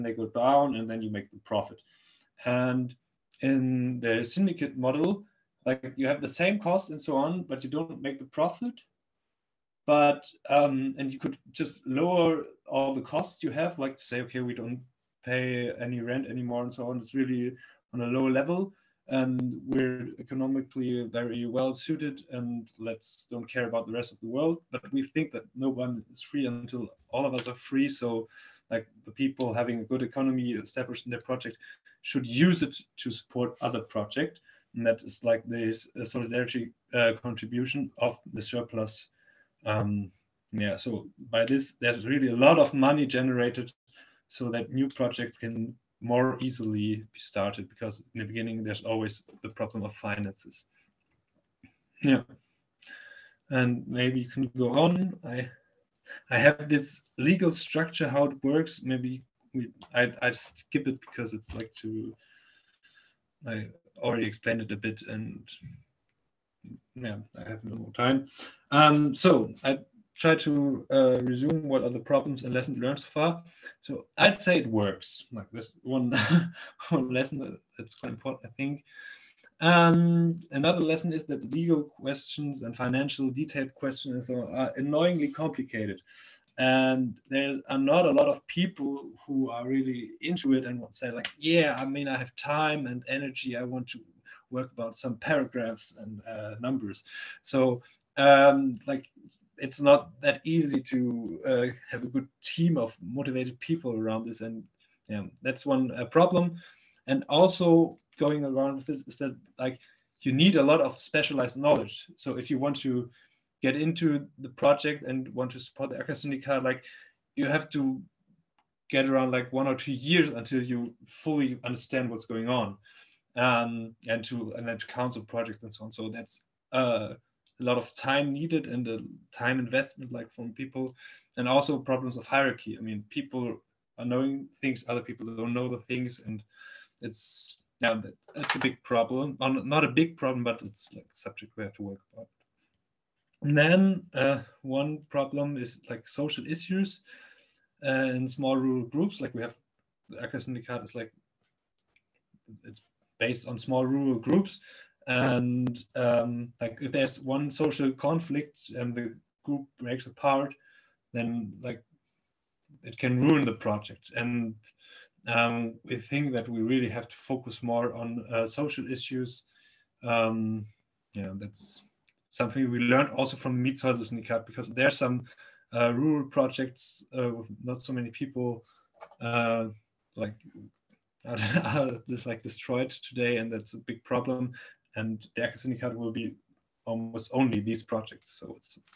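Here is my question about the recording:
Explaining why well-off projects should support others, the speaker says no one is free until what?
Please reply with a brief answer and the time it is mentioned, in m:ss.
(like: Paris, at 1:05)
All of us are free, at 0:27.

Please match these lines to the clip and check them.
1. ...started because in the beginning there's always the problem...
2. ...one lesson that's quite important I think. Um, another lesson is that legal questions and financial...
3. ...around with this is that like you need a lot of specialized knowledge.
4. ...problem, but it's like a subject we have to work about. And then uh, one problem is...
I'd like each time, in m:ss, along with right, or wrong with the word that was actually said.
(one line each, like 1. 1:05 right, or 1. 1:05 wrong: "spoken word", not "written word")
1. 0:47 right
2. 1:16 right
3. 1:48 right
4. 2:20 right.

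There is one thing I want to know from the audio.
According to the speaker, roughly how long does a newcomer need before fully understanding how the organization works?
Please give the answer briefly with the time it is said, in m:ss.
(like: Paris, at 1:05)
1 or 2 years, at 1:59.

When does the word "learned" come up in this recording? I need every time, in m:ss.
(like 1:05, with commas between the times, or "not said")
1:12, 2:52.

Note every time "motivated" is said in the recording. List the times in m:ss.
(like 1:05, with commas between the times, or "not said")
1:43.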